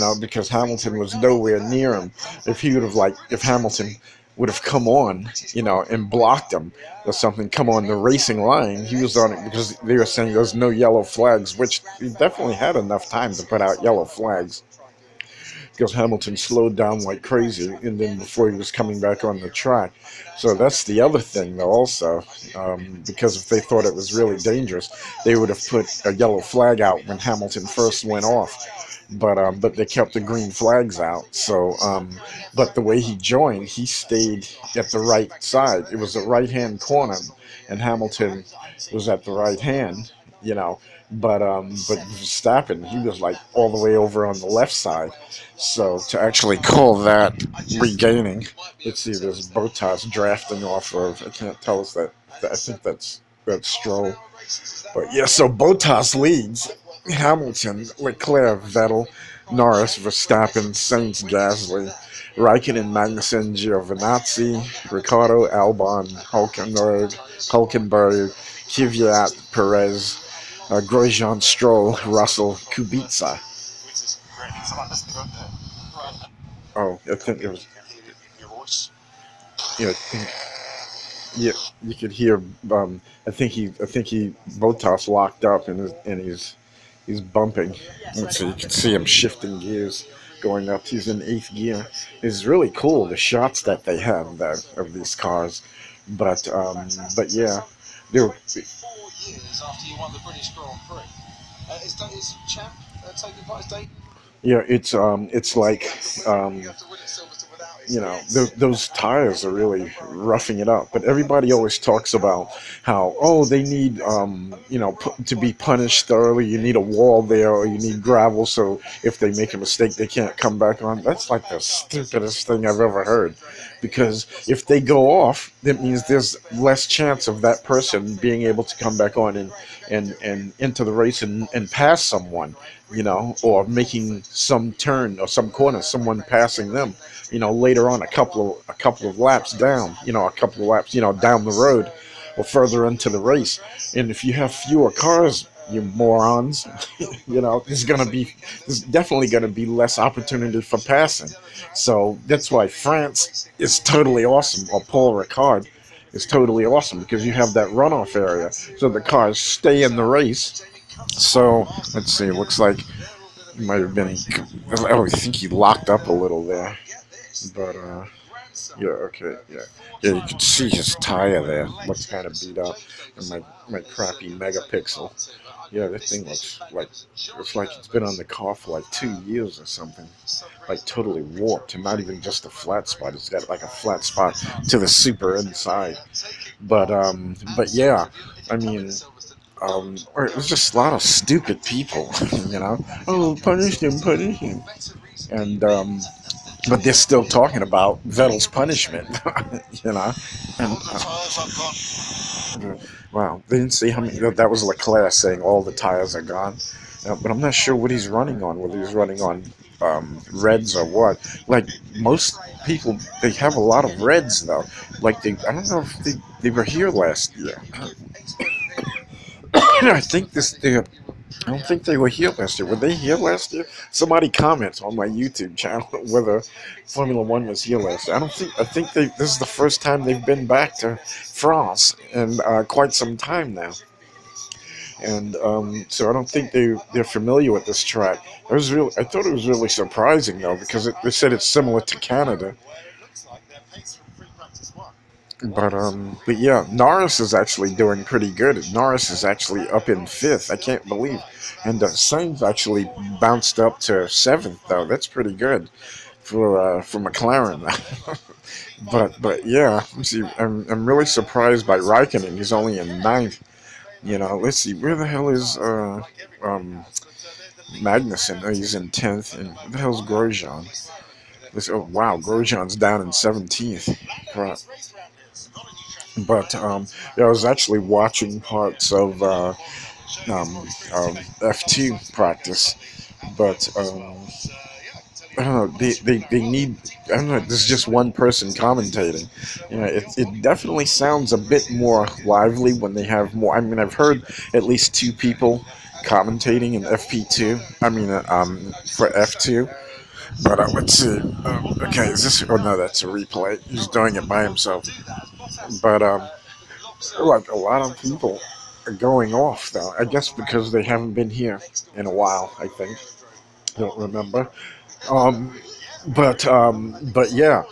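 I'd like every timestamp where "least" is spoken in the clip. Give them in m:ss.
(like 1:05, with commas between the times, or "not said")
4:54.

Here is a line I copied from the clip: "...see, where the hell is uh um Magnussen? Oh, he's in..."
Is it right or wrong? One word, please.
right.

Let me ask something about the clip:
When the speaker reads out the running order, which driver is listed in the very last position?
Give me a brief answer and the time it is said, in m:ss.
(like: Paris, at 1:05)
Kubica, at 1:12.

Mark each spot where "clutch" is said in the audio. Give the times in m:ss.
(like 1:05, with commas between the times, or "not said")
not said.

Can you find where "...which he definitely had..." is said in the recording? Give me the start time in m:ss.
0:11.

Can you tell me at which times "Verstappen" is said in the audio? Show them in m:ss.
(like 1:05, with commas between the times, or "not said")
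0:42, 0:59.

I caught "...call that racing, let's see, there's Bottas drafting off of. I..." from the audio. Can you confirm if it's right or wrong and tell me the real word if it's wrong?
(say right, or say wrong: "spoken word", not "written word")
wrong: "regaining", not "racing".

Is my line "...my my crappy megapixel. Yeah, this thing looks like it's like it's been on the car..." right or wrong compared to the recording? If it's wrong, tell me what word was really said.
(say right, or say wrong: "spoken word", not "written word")
right.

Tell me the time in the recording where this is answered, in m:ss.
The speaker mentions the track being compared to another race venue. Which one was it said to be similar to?
4:01.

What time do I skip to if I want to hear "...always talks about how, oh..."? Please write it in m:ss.
1:51.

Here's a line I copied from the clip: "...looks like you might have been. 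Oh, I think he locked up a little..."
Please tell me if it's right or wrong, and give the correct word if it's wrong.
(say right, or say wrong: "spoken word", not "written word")
right.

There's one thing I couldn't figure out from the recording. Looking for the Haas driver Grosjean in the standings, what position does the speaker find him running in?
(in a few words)
17th.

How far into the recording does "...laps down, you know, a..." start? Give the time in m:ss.
2:19.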